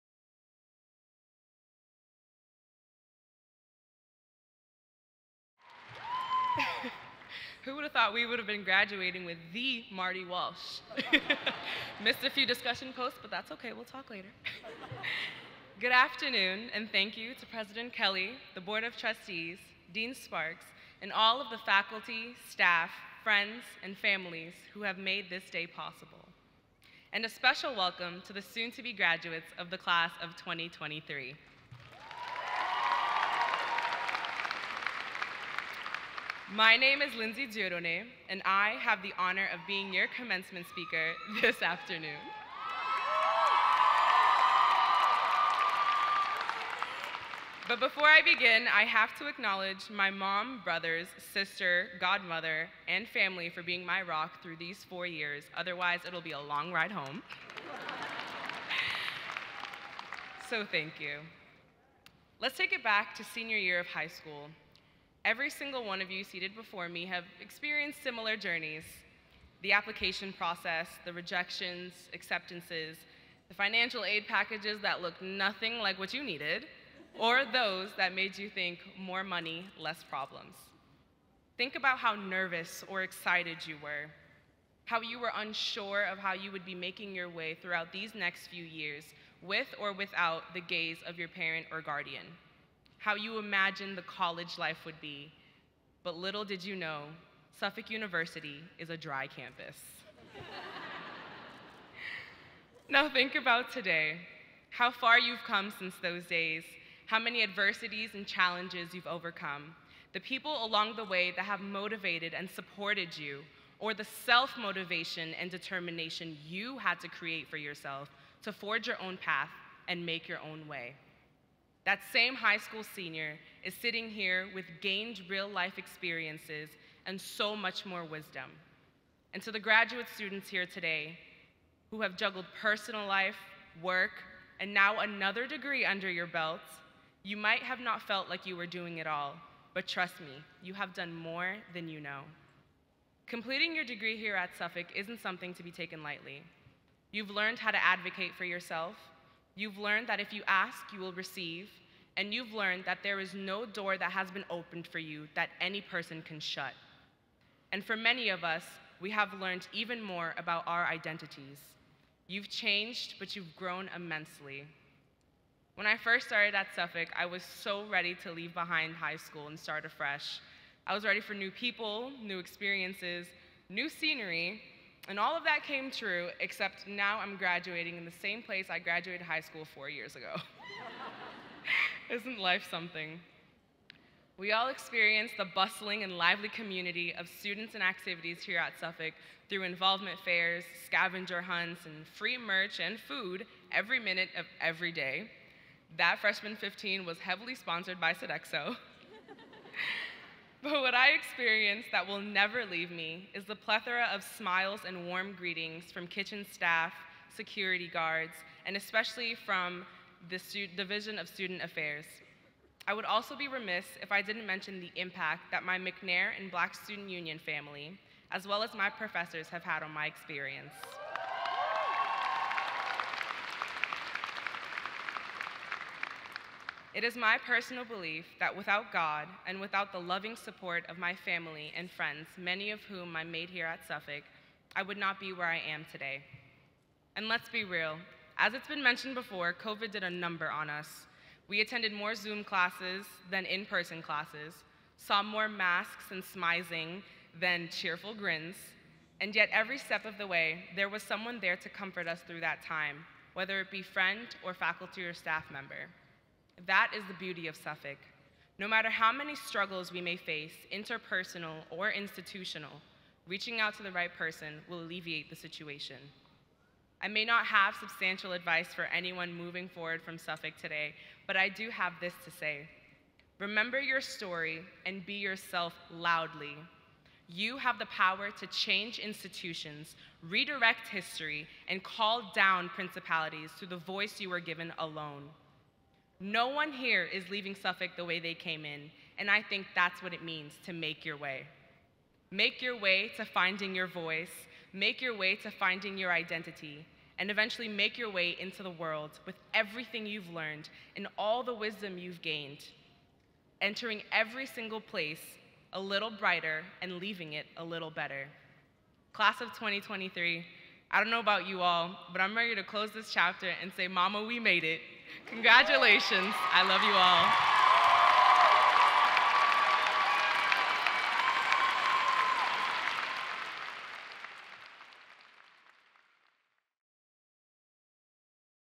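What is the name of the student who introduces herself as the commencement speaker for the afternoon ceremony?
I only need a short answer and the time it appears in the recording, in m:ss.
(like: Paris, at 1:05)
Lindsay Dieudonne, at 0:37.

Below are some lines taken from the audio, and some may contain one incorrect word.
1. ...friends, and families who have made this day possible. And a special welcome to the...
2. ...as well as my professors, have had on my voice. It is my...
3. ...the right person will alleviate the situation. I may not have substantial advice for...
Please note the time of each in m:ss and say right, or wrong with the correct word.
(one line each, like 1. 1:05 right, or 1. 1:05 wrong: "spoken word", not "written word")
1. 0:23 right
2. 3:38 wrong: "experience", not "voice"
3. 4:23 right.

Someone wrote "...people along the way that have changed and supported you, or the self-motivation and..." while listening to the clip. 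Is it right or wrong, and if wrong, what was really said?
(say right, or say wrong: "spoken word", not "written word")
wrong: "motivated", not "changed".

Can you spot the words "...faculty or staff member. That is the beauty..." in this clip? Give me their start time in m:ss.
4:14.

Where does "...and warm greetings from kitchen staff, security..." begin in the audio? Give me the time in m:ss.
3:24.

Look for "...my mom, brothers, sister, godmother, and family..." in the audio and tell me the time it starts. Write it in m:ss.
0:49.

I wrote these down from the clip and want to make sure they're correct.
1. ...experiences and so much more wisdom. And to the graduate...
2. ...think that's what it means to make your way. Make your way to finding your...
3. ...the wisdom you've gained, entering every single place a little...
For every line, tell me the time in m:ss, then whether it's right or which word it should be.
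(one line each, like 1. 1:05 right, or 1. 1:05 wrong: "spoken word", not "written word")
1. 2:05 right
2. 4:49 right
3. 5:01 right.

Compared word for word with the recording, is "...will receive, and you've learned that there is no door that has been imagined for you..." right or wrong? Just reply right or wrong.
wrong.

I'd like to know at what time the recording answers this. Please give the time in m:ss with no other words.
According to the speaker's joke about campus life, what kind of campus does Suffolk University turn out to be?
1:38.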